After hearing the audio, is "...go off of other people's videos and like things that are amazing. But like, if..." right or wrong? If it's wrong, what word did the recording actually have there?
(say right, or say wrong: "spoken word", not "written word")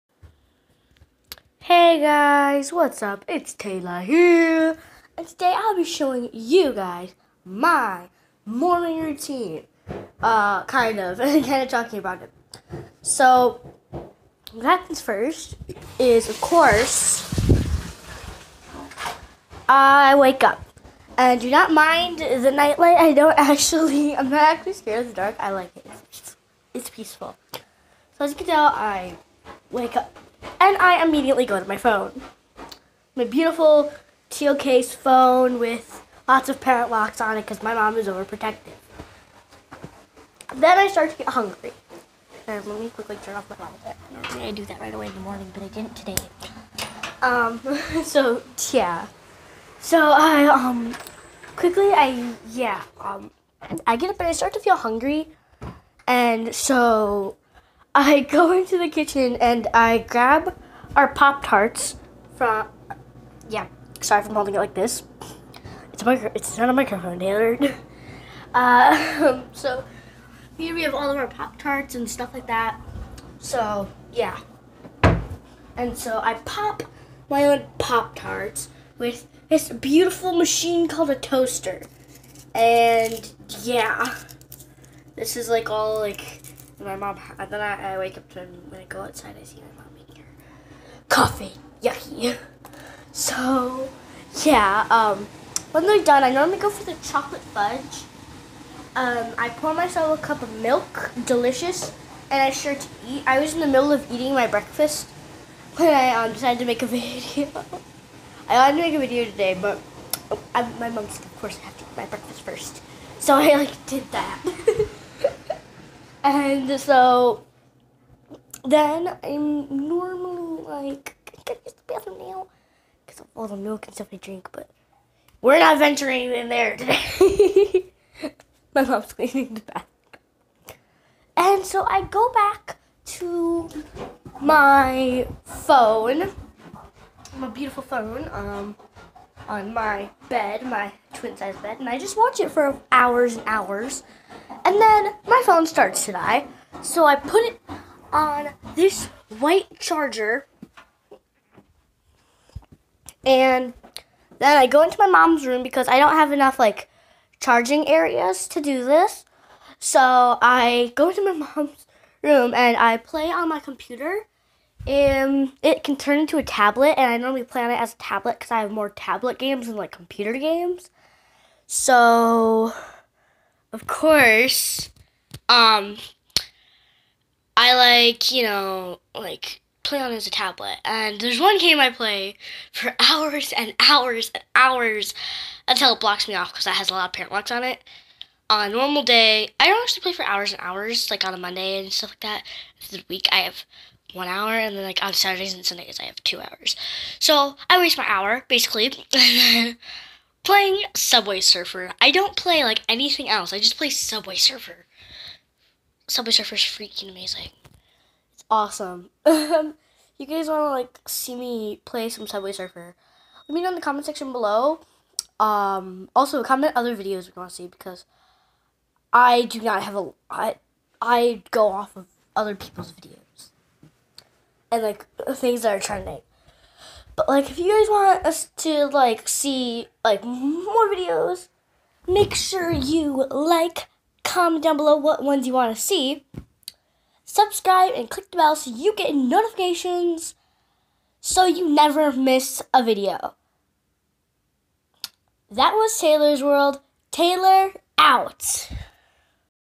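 wrong: "trending", not "amazing".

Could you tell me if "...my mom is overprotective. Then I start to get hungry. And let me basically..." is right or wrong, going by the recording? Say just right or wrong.
wrong.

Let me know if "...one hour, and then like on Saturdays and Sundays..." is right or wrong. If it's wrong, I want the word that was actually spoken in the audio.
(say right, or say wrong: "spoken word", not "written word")
right.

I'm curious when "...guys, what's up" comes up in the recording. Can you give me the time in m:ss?
0:02.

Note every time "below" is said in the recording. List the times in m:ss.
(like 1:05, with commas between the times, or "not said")
3:34, 3:54.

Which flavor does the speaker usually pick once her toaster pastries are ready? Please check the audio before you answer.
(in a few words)
Chocolate fudge.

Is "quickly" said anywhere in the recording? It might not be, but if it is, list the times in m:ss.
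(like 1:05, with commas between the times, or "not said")
0:42, 0:51.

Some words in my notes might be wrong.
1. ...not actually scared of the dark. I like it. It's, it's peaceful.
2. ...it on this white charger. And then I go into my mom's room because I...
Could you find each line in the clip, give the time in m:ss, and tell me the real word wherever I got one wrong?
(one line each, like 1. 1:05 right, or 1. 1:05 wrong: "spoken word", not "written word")
1. 0:24 right
2. 2:27 right.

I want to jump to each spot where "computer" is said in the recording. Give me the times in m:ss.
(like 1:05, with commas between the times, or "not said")
2:43, 2:49.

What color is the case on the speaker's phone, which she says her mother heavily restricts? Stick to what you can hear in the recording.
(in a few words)
Teal.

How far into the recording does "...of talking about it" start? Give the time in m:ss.
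0:11.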